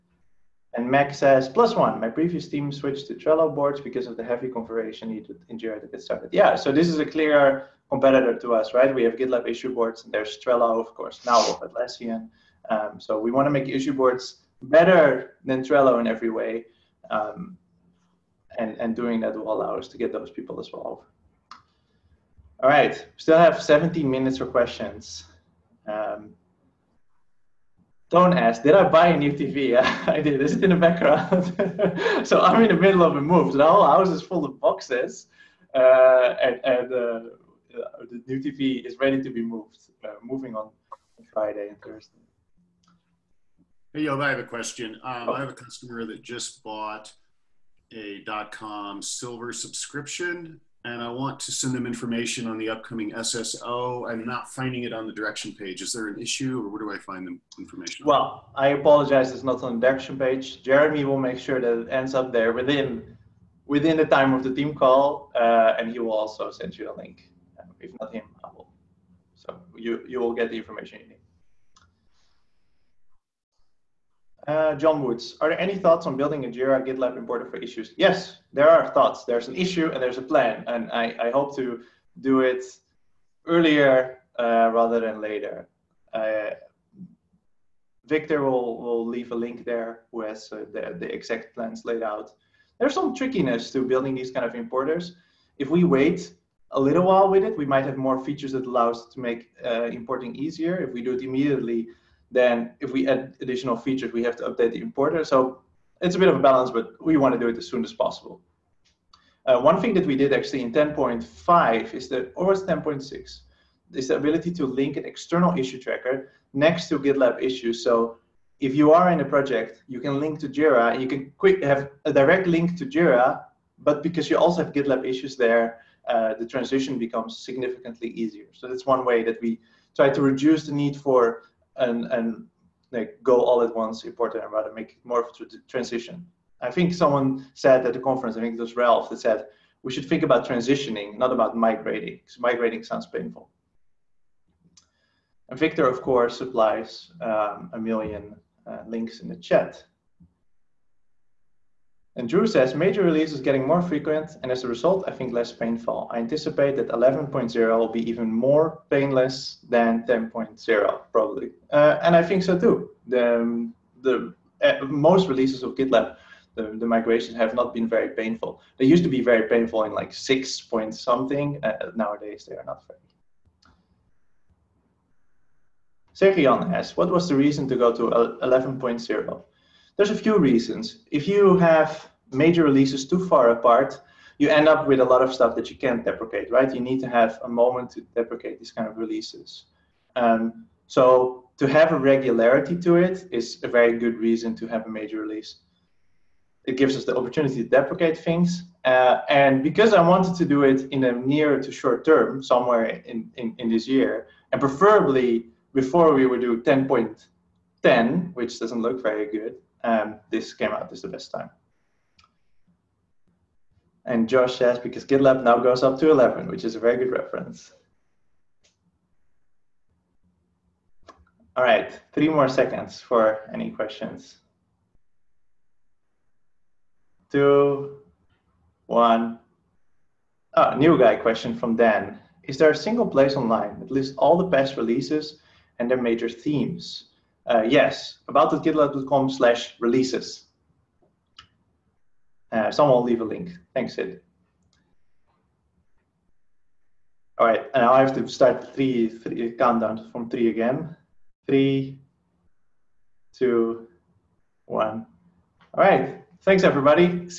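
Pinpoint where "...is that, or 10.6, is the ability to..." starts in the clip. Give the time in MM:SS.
01:51.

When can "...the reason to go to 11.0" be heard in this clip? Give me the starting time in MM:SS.
02:57.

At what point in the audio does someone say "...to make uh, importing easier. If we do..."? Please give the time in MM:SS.
01:39.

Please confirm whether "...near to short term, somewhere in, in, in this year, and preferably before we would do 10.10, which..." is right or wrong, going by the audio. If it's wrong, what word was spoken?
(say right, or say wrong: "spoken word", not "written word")
right.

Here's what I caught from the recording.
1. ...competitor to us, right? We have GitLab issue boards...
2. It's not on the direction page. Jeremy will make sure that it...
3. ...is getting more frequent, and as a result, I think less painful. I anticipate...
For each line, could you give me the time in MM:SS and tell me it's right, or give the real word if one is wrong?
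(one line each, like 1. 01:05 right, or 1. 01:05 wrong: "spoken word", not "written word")
1. 00:07 right
2. 00:59 right
3. 02:33 right.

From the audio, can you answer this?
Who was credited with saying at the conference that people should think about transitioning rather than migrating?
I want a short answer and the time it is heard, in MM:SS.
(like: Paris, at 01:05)
Ralph, at 02:18.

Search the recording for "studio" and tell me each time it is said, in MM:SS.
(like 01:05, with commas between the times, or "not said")
not said.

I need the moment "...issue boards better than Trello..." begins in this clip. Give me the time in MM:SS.
00:13.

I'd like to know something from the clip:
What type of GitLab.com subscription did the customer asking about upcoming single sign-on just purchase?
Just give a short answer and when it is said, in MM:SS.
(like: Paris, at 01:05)
Silver, at 00:49.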